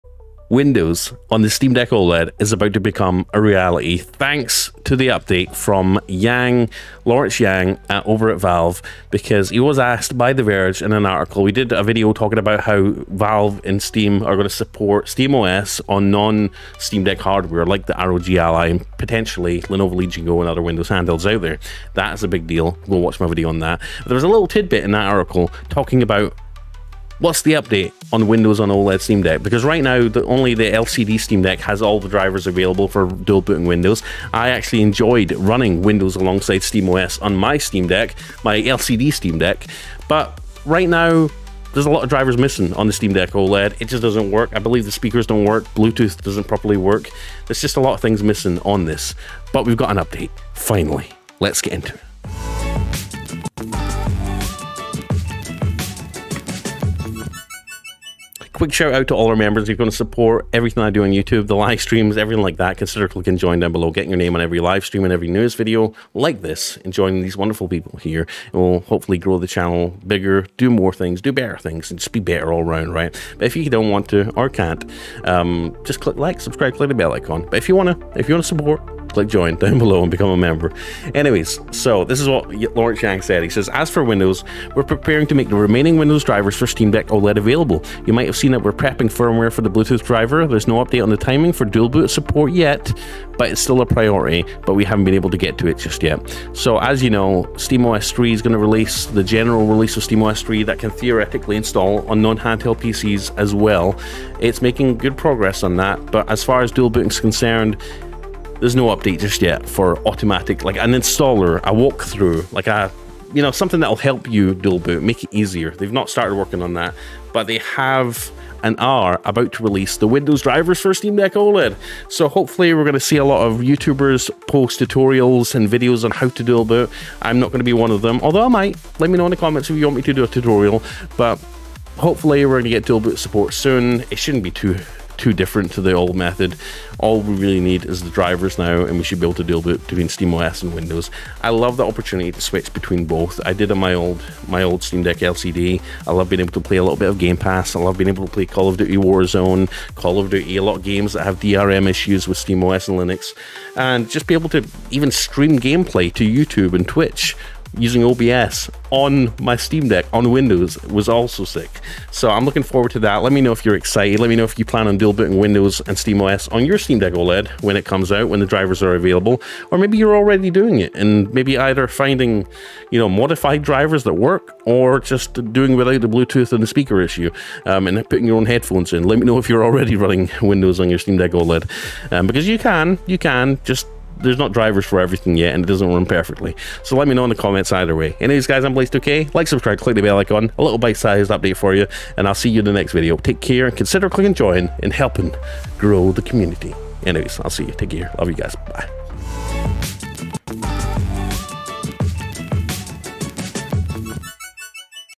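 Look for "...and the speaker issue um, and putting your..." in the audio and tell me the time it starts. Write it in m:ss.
2:56.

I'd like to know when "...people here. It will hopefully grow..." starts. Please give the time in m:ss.
1:07.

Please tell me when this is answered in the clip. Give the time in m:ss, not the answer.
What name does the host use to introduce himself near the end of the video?
3:08.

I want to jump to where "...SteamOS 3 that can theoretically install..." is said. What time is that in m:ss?
1:40.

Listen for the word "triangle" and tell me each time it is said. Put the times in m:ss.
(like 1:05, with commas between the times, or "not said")
not said.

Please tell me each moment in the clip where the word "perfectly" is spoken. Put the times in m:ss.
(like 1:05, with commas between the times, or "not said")
3:06.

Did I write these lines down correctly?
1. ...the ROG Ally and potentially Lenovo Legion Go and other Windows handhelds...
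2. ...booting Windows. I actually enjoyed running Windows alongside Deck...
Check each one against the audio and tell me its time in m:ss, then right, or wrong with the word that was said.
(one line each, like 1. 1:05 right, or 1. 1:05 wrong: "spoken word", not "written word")
1. 0:17 right
2. 0:33 wrong: "SteamOS", not "Deck".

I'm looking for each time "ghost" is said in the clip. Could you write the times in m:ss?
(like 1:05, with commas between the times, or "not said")
not said.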